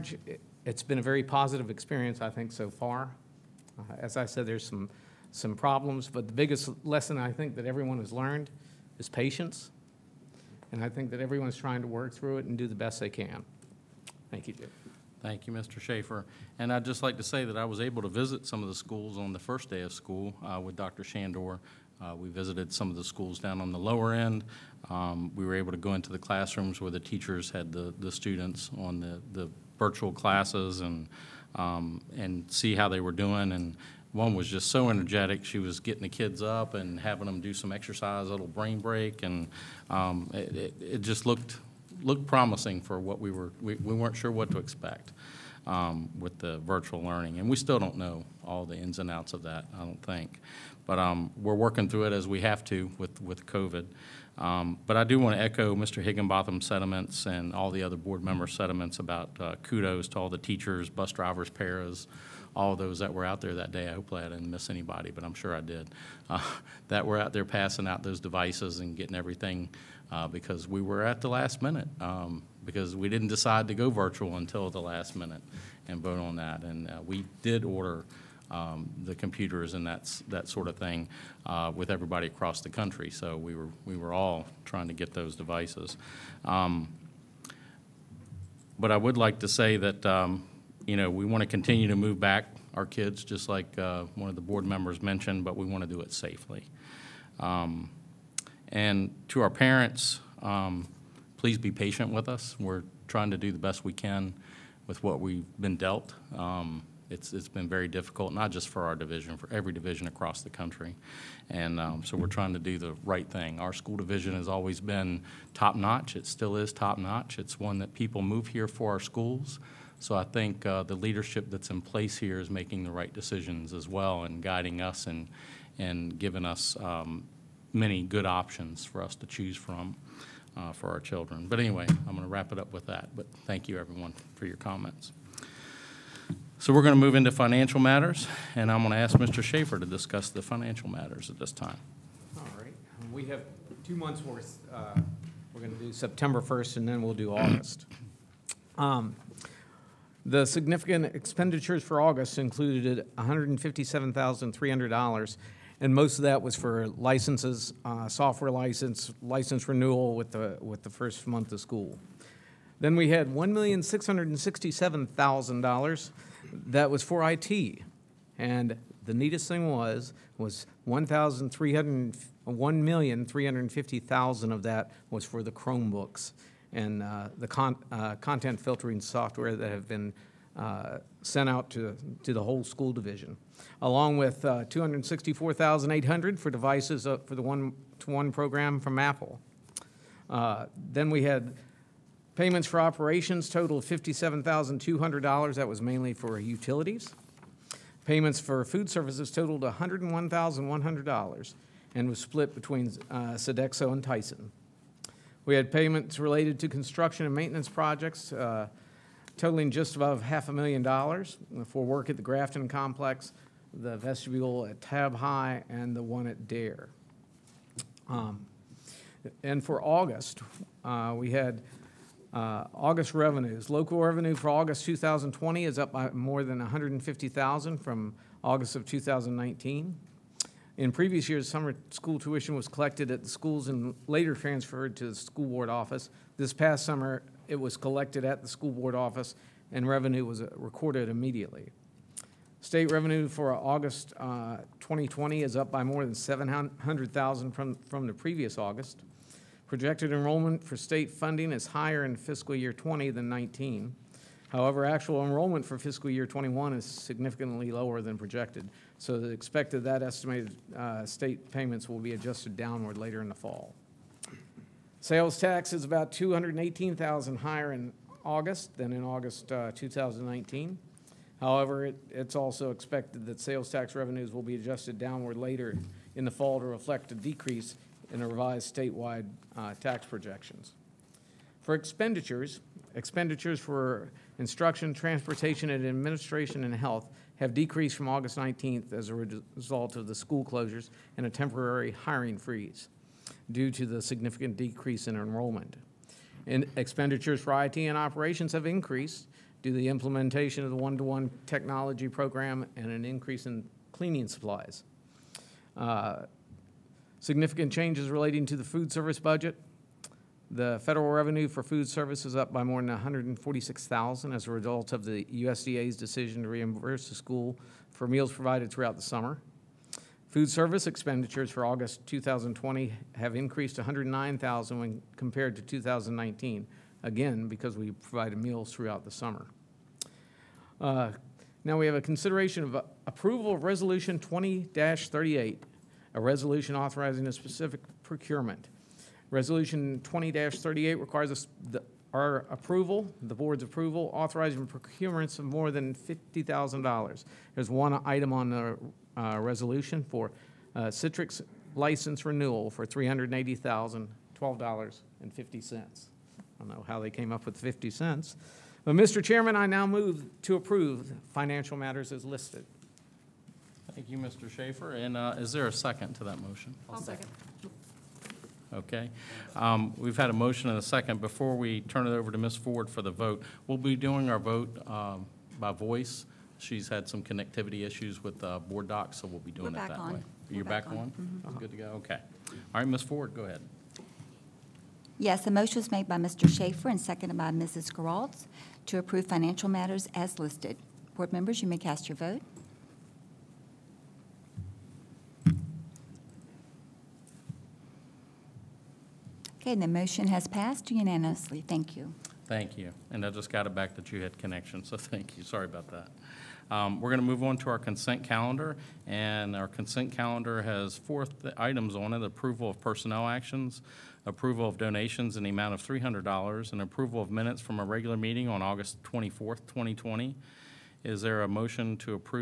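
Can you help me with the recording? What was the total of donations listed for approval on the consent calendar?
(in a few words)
$300.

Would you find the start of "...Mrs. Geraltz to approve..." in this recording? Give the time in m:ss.
6:27.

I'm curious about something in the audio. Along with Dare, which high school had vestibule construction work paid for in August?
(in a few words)
Tabb High.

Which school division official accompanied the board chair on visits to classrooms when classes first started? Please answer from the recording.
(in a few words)
Dr. Shandor.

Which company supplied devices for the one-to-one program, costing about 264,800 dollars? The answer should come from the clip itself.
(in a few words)
Apple.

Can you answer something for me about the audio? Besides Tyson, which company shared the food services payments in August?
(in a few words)
Sodexo.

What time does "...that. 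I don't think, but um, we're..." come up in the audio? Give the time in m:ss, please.
0:49.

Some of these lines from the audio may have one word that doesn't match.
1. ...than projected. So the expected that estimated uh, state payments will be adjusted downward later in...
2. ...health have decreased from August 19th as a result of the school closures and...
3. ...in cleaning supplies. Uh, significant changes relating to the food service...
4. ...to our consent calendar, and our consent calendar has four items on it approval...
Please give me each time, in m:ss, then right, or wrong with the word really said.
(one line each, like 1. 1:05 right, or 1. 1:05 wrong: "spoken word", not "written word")
1. 4:18 right
2. 4:46 right
3. 5:03 right
4. 6:47 right.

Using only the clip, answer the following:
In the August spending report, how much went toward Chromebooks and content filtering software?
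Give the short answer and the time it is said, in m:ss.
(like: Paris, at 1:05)
$1,350,000, at 2:52.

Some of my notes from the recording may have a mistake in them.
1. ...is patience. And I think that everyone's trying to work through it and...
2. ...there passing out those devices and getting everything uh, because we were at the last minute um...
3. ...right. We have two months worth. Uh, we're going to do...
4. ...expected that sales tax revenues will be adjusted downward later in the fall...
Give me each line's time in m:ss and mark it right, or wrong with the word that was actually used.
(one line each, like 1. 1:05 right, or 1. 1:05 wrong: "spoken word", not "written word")
1. 0:08 right
2. 1:07 right
3. 2:22 right
4. 4:32 right.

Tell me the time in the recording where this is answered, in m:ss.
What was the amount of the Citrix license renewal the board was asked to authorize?
5:52.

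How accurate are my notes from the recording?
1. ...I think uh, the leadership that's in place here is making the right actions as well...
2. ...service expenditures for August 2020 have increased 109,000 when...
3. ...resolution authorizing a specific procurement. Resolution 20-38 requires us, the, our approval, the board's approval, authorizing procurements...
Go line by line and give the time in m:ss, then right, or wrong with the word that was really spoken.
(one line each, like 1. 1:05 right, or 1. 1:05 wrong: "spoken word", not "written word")
1. 2:00 wrong: "decisions", not "actions"
2. 5:20 right
3. 5:36 right.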